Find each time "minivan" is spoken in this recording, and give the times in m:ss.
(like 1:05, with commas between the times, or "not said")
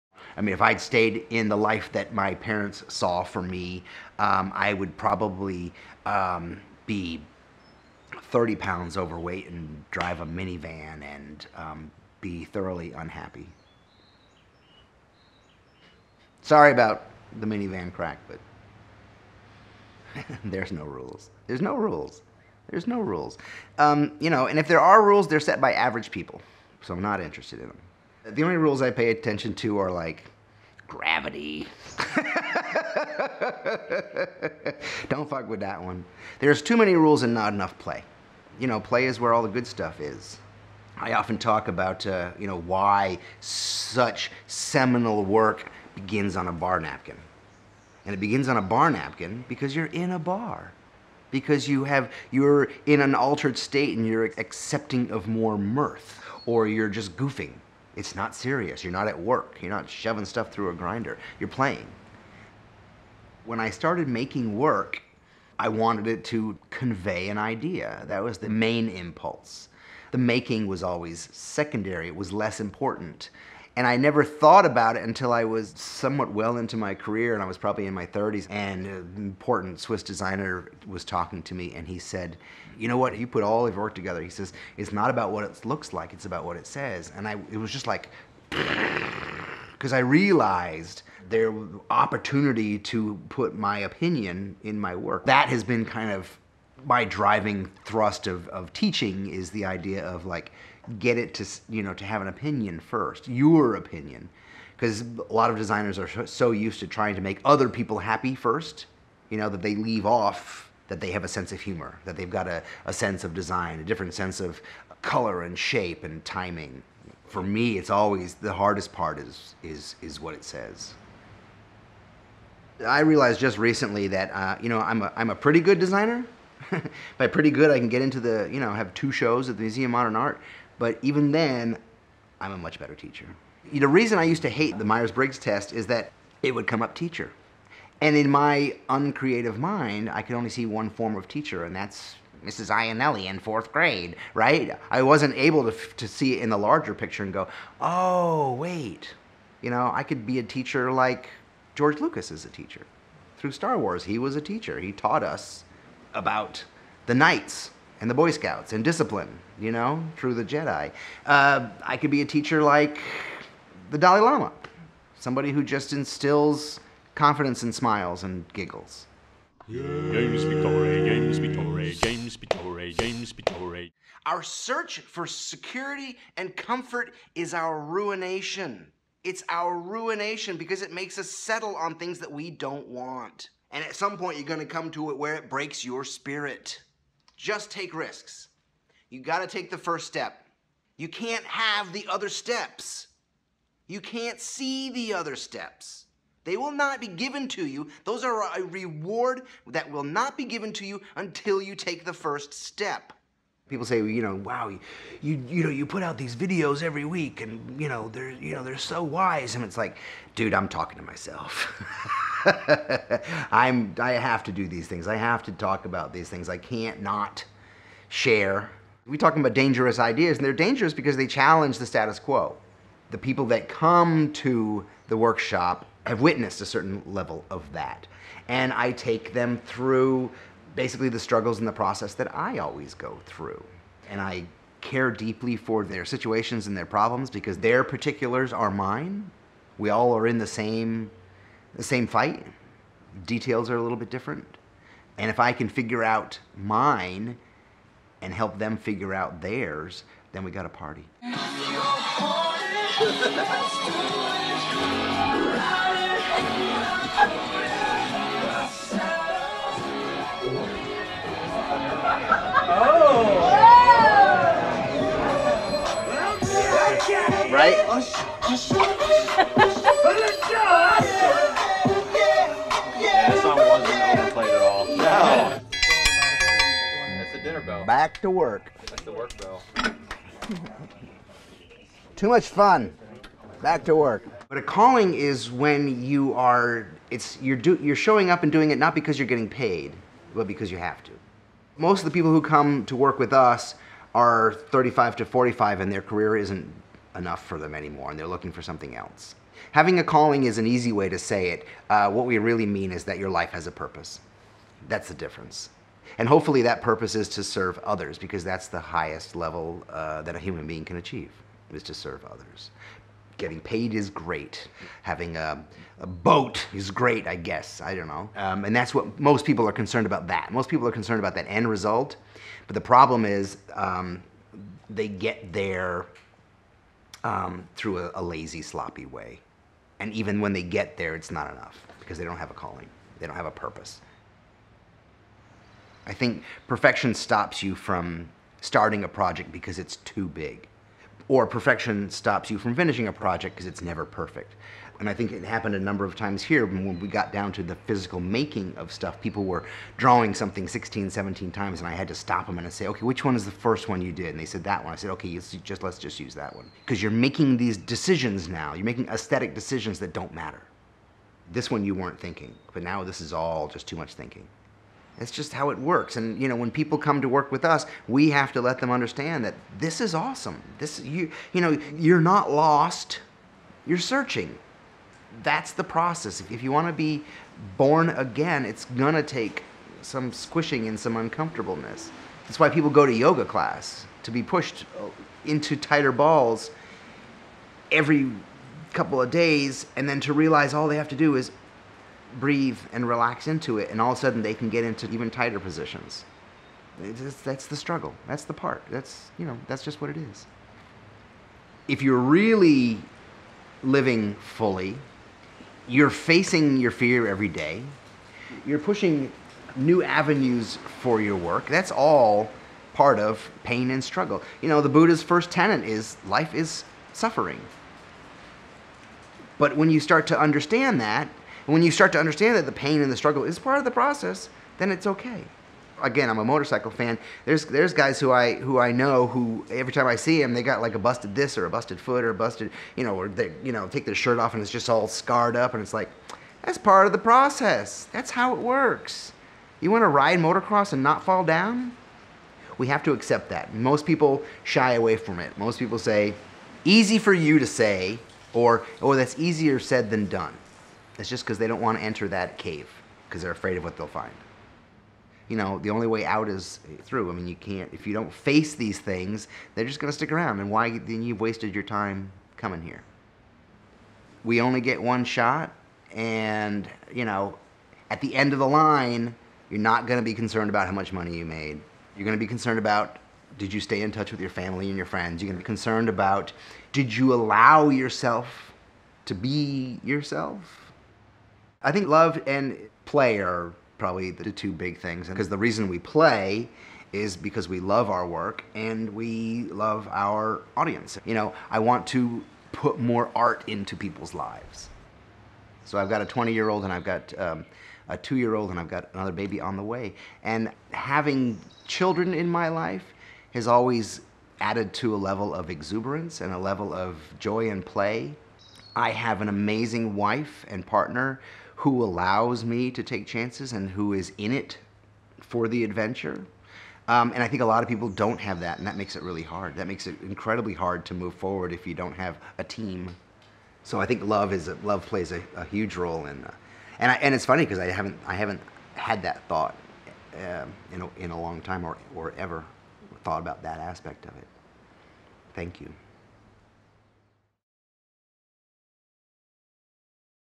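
0:10, 0:17.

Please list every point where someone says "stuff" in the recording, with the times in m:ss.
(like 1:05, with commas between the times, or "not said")
0:39, 1:00, 5:48.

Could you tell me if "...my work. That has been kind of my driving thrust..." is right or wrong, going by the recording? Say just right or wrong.
right.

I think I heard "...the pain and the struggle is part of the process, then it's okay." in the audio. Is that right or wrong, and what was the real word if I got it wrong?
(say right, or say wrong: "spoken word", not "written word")
right.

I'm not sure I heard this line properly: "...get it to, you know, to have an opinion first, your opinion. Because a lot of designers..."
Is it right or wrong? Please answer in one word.
right.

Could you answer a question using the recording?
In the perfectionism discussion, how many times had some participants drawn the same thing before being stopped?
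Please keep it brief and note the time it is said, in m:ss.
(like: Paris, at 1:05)
16 or 17, at 5:50.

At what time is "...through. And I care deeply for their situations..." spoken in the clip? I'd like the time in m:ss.
3:53.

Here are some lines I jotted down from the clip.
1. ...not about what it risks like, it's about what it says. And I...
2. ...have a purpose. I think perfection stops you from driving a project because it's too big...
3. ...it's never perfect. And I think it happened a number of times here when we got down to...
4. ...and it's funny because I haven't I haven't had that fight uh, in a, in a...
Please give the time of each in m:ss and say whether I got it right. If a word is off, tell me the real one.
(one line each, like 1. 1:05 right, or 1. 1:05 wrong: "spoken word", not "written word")
1. 1:24 wrong: "looks", not "risks"
2. 5:33 wrong: "starting", not "driving"
3. 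5:43 right
4. 8:47 wrong: "thought", not "fight".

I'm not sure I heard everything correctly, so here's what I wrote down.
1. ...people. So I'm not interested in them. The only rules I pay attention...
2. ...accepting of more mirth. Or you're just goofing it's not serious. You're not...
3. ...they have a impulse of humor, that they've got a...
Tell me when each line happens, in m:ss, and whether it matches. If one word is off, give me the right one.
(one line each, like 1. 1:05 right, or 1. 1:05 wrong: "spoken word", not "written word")
1. 0:26 right
2. 0:54 right
3. 1:50 wrong: "sense", not "impulse".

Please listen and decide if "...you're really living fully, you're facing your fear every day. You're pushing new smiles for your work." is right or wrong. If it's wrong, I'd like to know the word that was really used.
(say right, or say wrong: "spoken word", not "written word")
wrong: "avenues", not "smiles".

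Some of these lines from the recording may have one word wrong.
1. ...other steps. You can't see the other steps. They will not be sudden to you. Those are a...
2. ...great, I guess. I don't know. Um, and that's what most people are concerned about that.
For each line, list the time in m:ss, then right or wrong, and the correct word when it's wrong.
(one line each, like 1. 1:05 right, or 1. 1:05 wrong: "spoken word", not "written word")
1. 3:12 wrong: "given", not "sudden"
2. 5:16 right.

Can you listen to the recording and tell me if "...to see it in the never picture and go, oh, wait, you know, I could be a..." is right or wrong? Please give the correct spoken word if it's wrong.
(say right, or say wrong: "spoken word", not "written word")
wrong: "larger", not "never".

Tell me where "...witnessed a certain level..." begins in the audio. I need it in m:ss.
3:46.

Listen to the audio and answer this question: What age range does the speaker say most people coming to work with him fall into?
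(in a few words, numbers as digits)
35 to 45.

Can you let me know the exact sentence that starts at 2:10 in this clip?
But even then, I'm a much better teacher.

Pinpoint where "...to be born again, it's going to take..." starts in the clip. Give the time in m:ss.
6:16.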